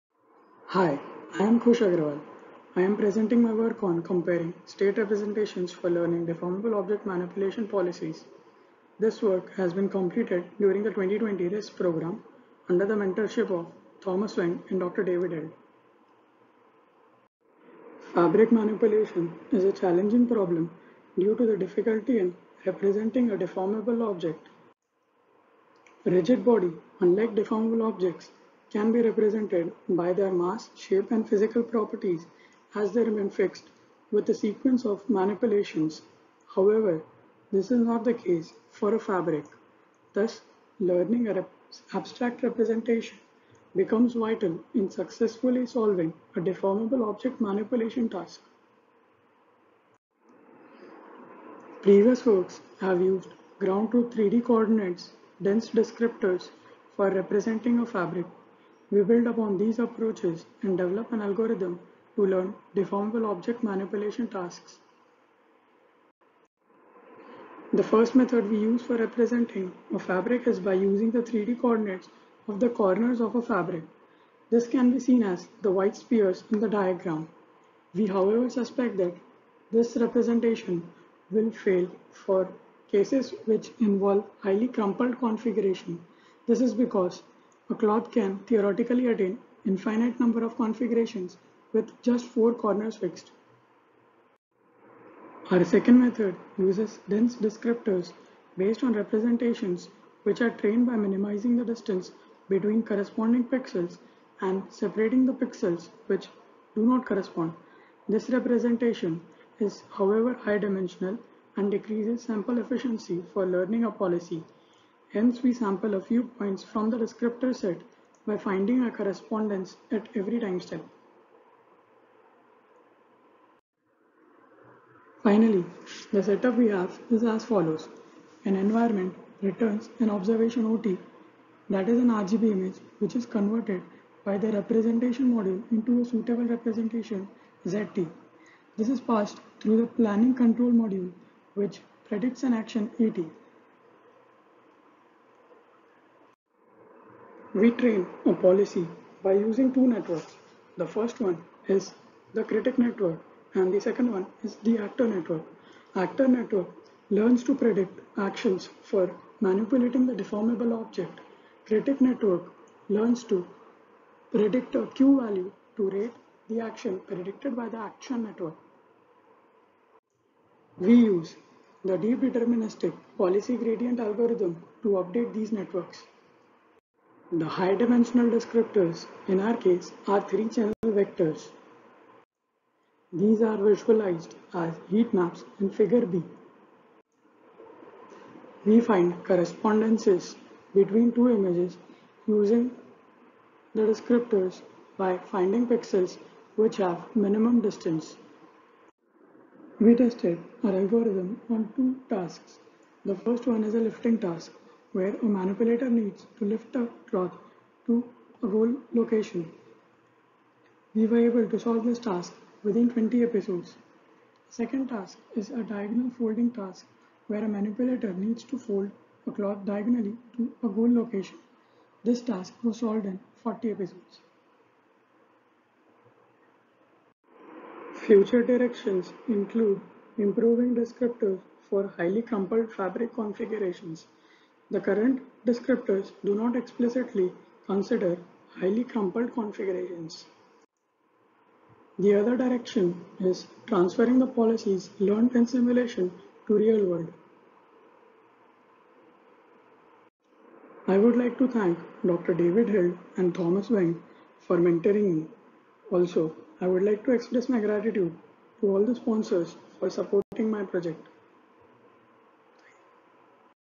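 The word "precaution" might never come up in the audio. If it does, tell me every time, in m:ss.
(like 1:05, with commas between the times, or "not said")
not said.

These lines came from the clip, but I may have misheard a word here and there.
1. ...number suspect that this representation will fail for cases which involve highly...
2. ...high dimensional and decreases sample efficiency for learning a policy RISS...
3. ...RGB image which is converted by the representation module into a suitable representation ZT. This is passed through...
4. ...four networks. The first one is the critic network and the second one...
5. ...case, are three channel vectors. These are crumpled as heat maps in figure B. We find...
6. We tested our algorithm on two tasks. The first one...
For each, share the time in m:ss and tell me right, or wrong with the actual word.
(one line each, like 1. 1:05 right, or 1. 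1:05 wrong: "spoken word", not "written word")
1. 1:18 wrong: "however", not "number"
2. 1:50 wrong: "Hence", not "RISS"
3. 2:12 right
4. 2:29 wrong: "two", not "four"
5. 2:59 wrong: "visualized", not "crumpled"
6. 3:19 right.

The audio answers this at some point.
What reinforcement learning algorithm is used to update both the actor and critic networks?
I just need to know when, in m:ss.
2:51.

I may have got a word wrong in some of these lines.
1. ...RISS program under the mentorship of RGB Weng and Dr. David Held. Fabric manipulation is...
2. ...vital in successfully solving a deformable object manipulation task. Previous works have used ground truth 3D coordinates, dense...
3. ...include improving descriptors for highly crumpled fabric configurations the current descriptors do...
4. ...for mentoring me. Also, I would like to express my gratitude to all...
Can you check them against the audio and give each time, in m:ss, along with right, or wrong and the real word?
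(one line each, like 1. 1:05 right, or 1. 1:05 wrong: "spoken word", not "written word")
1. 0:11 wrong: "Thomas", not "RGB"
2. 0:44 right
3. 3:49 right
4. 4:14 right.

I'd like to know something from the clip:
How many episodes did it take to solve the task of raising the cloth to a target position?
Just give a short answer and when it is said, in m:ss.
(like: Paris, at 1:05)
20, at 3:32.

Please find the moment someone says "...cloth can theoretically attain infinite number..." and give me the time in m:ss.
1:27.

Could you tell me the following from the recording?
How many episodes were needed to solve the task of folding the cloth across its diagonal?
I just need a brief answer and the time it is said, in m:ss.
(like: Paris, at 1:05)
40, at 3:43.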